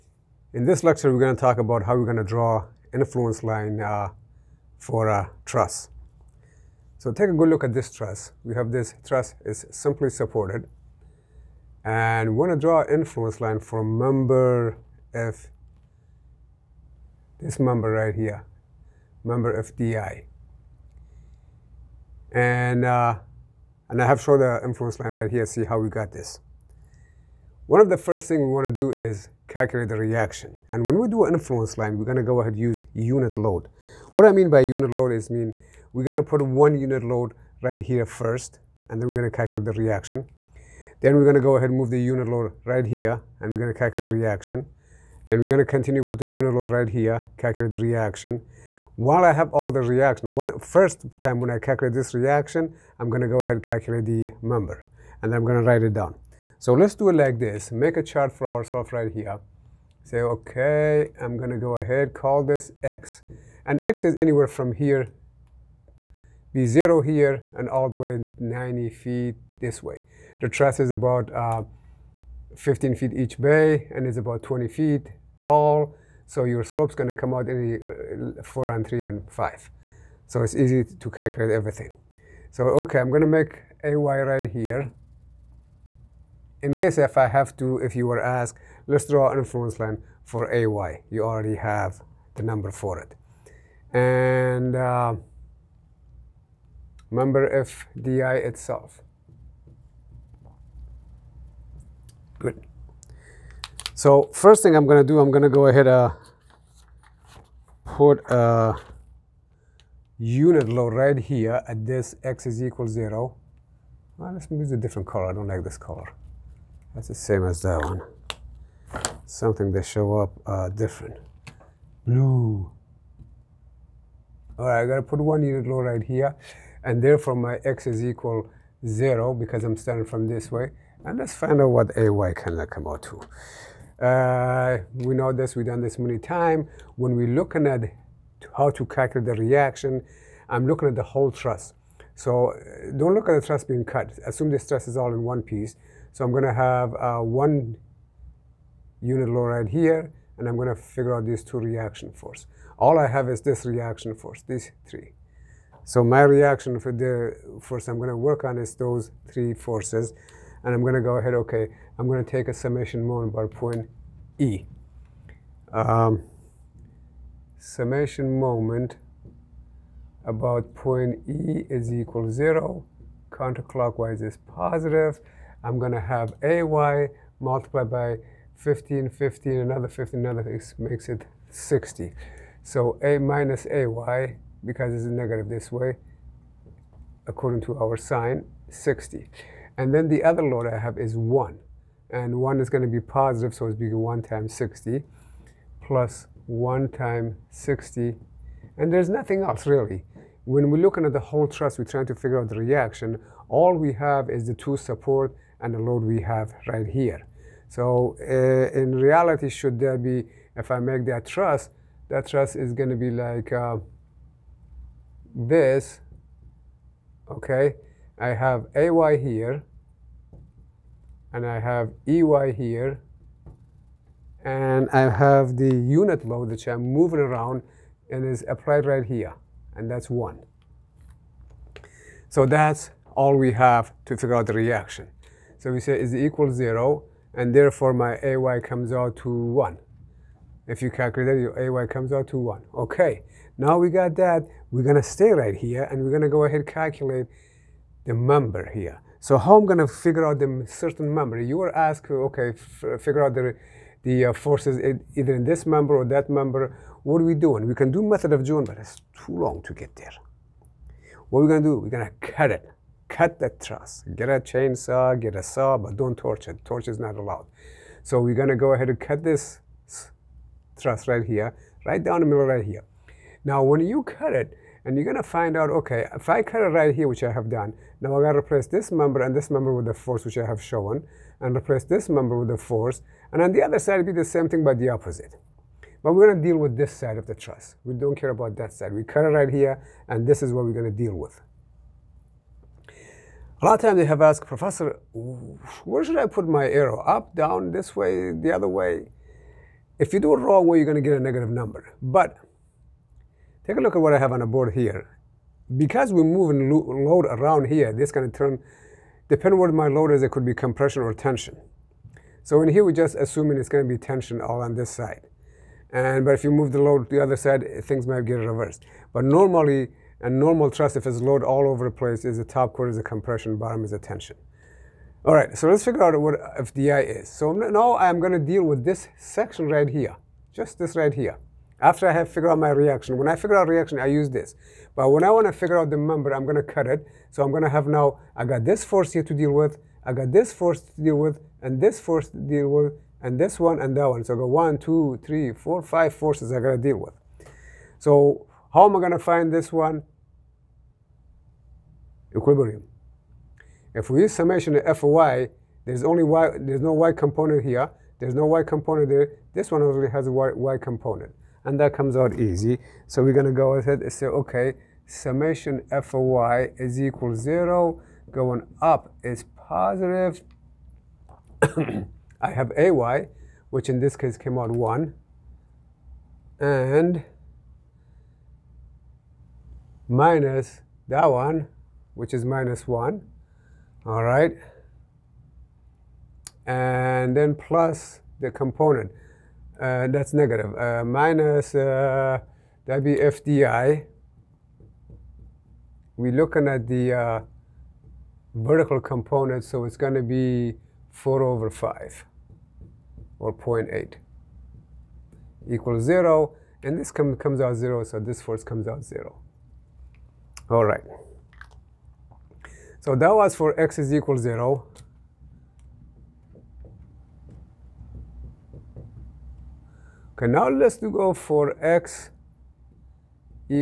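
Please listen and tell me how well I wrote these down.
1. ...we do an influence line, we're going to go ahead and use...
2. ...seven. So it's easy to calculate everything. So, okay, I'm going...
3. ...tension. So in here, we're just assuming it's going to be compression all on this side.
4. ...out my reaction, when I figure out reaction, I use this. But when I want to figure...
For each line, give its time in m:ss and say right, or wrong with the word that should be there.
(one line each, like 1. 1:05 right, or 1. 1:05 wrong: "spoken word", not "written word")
1. 0:30 right
2. 1:19 wrong: "five", not "seven"
3. 5:11 wrong: "tension", not "compression"
4. 5:32 right.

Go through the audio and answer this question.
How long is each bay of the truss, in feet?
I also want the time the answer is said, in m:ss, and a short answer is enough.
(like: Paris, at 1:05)
15 feet, at 1:12.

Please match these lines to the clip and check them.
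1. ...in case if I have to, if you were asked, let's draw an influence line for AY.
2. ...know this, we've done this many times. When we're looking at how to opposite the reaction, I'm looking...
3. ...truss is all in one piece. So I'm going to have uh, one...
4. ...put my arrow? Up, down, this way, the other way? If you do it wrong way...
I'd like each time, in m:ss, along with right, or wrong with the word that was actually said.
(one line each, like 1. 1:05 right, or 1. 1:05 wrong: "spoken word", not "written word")
1. 1:26 right
2. 2:15 wrong: "calculate", not "opposite"
3. 2:24 right
4. 4:56 right.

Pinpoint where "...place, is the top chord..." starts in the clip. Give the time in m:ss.
5:21.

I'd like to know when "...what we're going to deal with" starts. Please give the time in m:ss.
4:50.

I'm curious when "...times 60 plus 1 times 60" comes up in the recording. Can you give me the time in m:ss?
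3:14.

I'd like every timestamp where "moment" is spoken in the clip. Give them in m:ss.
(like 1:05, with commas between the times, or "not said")
2:43, 2:48.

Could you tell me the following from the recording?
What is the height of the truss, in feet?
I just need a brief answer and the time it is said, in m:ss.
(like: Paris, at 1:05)
20 feet, at 1:14.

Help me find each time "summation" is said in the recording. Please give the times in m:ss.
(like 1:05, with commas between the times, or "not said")
2:42, 2:47, 5:54, 6:05.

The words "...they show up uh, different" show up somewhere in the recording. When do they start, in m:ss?
1:59.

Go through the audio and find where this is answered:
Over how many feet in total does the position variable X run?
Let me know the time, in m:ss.
1:08.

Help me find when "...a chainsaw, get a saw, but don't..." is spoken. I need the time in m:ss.
4:24.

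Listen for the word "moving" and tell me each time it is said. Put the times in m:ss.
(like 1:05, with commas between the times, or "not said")
3:46, 5:06.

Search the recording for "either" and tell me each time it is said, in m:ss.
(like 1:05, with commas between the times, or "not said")
4:15.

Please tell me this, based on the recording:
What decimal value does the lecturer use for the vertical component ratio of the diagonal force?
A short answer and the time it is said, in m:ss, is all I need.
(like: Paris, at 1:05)
0.8, at 6:43.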